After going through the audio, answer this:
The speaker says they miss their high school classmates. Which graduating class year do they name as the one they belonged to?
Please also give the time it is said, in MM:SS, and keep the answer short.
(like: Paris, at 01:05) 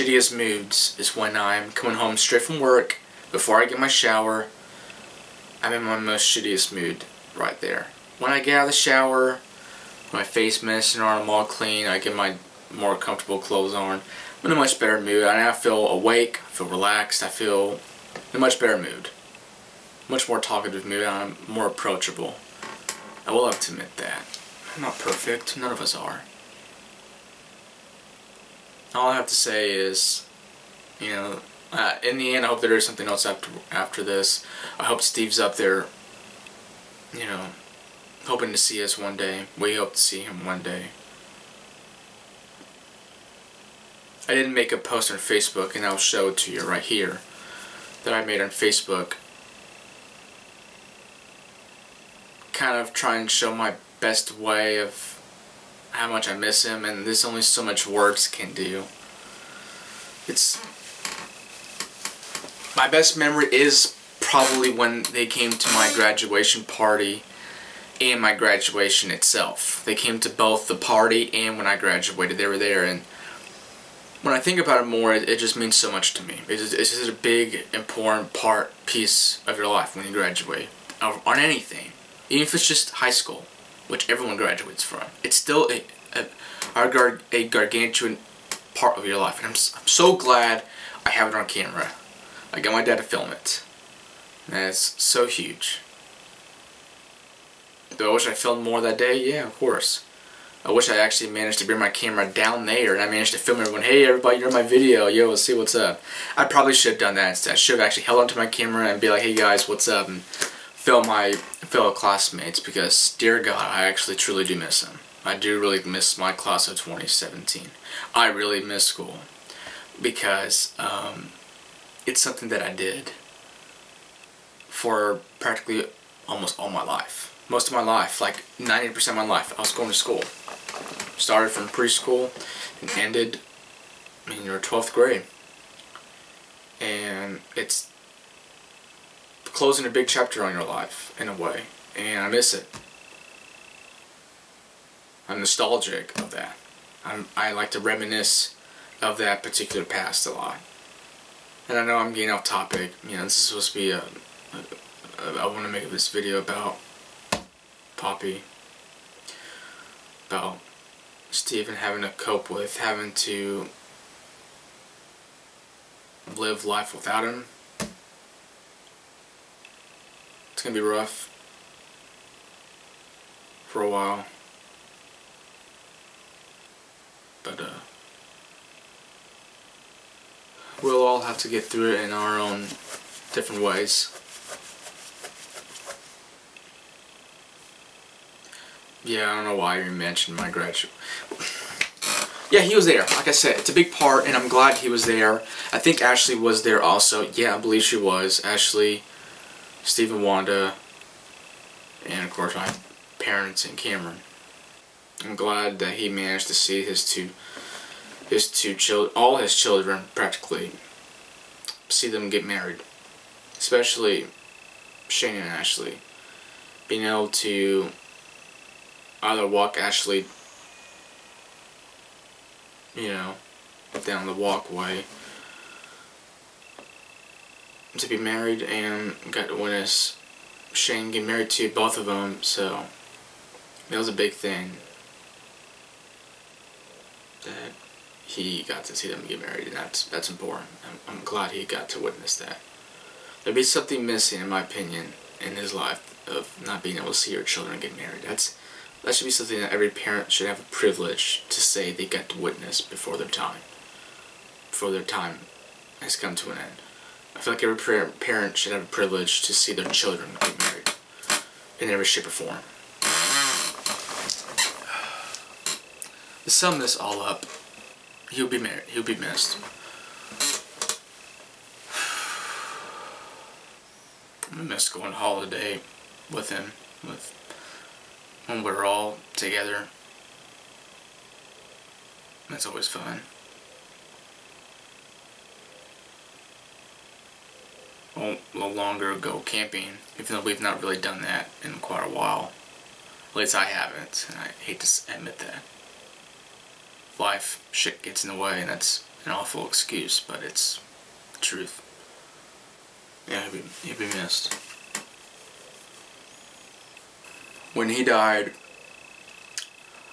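2017, at 01:56.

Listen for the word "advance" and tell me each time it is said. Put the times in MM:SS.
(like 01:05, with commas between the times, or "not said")
not said.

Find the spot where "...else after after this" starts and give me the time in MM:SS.
00:33.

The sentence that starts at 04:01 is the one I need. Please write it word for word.
I'm, I'm glad he got to witness that.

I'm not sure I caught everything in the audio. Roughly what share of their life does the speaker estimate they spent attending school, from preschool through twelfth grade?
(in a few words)
90%.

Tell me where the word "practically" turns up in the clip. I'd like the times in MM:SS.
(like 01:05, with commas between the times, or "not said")
02:05, 03:30.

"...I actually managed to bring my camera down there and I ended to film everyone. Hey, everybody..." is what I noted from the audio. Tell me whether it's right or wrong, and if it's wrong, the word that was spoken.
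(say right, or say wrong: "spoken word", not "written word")
wrong: "managed", not "ended".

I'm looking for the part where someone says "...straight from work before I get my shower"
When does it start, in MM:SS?
00:02.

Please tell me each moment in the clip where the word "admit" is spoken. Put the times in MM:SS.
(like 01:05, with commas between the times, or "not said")
00:23, 04:55.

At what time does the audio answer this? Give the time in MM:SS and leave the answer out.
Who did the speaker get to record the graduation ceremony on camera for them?
01:32.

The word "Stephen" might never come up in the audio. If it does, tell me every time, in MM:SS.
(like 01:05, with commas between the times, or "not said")
02:41, 03:19.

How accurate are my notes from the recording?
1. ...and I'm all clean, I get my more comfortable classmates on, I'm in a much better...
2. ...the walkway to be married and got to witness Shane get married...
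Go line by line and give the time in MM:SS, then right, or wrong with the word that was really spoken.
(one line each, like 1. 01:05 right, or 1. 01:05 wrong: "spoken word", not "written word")
1. 00:10 wrong: "clothes", not "classmates"
2. 03:44 right.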